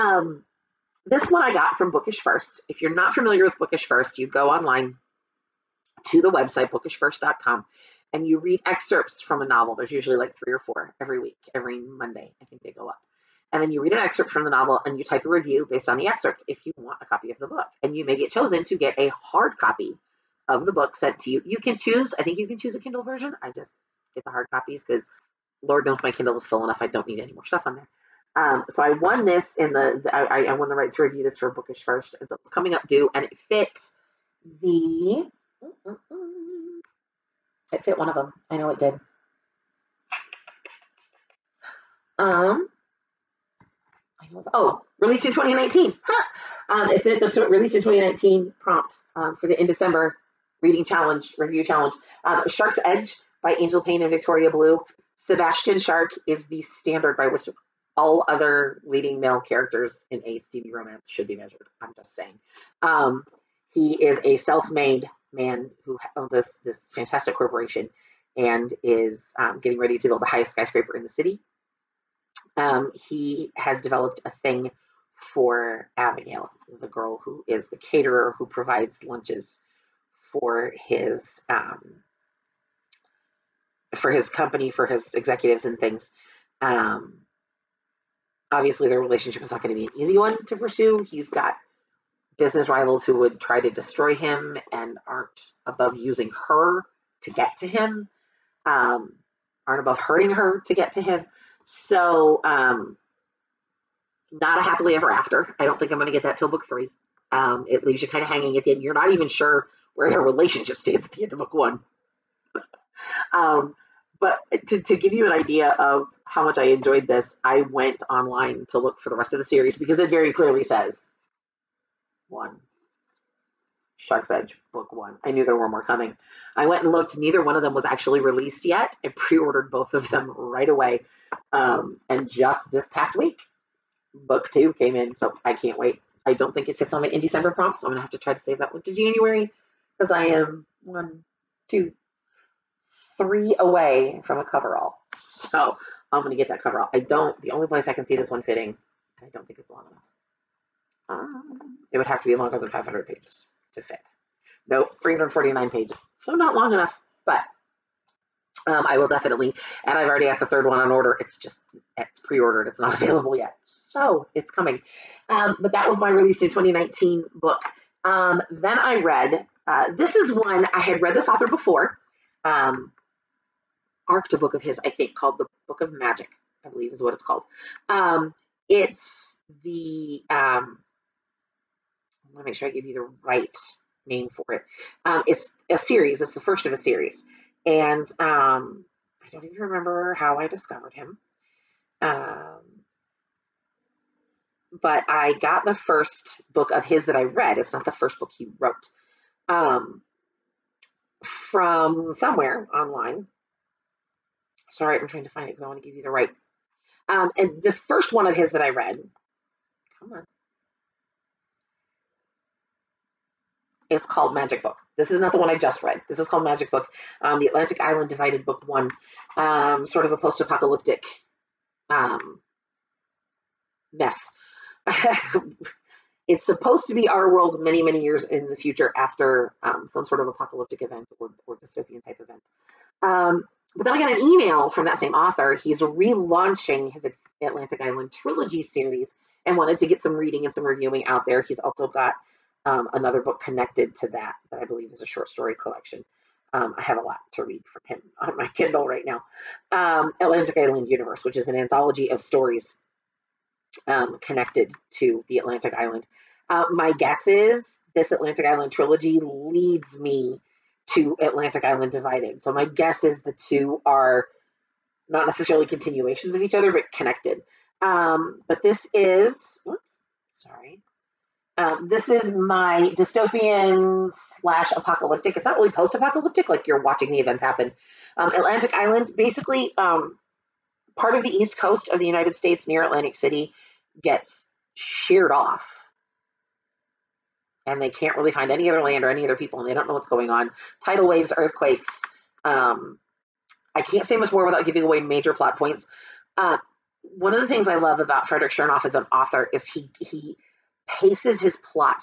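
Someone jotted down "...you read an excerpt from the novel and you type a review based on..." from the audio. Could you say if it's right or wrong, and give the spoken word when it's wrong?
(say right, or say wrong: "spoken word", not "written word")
right.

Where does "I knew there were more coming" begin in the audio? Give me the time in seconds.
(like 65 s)
125 s.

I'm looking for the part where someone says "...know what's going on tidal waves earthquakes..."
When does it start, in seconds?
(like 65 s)
289 s.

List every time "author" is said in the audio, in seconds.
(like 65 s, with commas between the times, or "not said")
171 s, 235 s, 299 s.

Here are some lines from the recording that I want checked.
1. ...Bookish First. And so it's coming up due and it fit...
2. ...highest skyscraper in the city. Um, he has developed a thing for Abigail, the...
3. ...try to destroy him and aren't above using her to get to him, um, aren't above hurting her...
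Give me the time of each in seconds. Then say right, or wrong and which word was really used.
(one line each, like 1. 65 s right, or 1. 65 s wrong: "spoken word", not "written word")
1. 31 s right
2. 70 s right
3. 93 s right.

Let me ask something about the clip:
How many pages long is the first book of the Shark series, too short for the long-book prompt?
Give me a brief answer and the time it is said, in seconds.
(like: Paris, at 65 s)
349, at 155 s.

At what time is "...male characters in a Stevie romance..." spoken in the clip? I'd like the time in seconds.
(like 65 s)
59 s.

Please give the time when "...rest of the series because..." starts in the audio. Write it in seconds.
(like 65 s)
119 s.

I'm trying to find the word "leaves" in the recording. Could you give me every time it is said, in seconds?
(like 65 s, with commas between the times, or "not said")
107 s.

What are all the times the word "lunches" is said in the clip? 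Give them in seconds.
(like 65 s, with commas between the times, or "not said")
79 s.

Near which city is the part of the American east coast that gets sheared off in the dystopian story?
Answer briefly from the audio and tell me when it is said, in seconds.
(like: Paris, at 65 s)
Atlantic City, at 282 s.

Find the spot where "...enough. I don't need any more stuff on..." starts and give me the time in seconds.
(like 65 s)
26 s.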